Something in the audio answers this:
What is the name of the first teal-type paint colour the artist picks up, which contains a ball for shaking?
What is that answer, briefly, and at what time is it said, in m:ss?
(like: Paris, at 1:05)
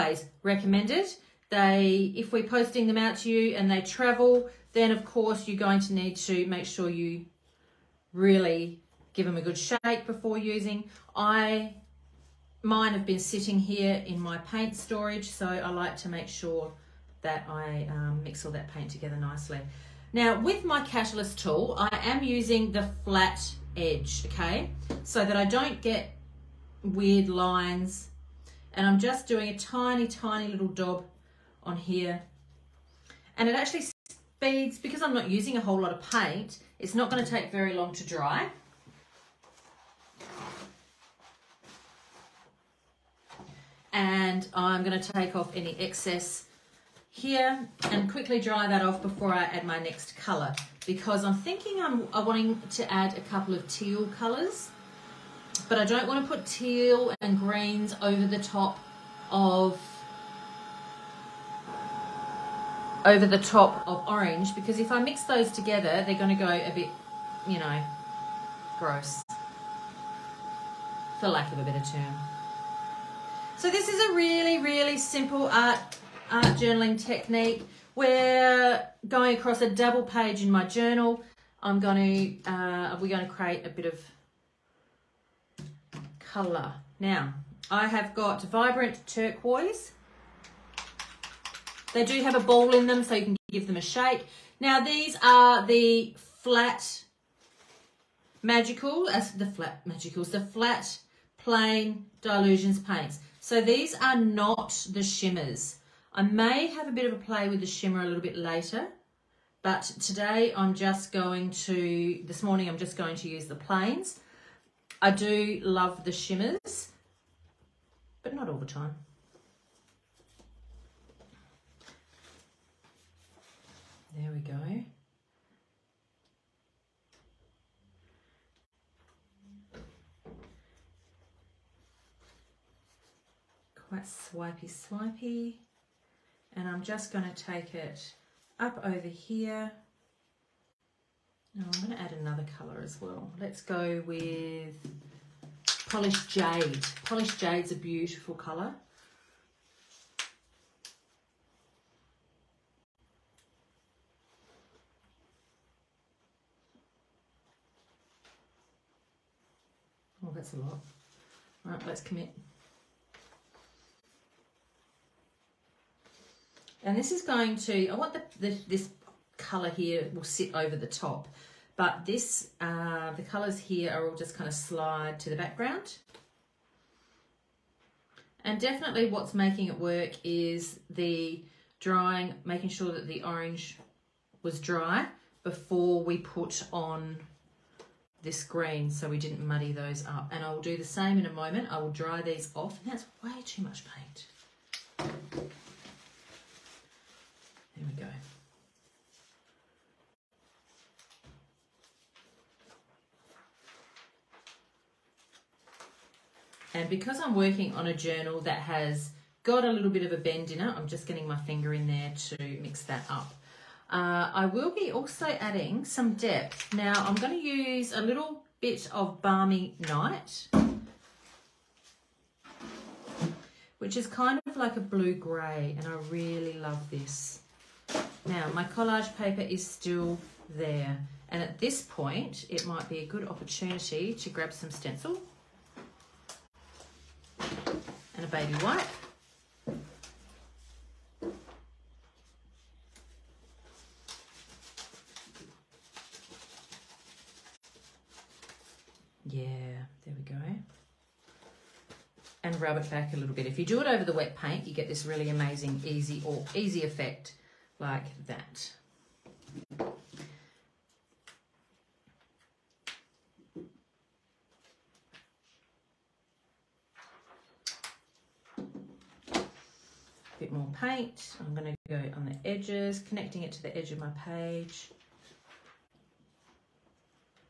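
Vibrant Turquoise, at 1:28.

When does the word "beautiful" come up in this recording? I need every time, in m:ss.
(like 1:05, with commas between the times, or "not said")
2:27.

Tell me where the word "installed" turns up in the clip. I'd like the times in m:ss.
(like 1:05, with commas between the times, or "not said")
not said.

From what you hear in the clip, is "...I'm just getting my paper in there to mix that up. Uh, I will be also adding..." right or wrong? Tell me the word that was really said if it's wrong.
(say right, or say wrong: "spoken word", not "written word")
wrong: "finger", not "paper".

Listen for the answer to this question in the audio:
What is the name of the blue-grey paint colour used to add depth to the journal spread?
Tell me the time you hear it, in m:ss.
3:39.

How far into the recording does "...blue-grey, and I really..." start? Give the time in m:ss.
3:44.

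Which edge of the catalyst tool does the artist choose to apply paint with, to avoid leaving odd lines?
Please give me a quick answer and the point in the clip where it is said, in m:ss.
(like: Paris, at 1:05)
Flat edge, at 0:22.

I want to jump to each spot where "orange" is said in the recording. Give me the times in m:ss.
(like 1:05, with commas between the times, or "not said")
1:04, 3:03.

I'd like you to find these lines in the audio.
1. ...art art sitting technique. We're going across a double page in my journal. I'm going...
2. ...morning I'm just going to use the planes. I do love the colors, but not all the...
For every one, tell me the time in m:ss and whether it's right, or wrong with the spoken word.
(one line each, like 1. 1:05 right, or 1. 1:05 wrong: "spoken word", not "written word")
1. 1:15 wrong: "journaling", not "sitting"
2. 1:52 wrong: "shimmers", not "colors".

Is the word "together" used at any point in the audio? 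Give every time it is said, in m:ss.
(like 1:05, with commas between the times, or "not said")
0:18, 1:05.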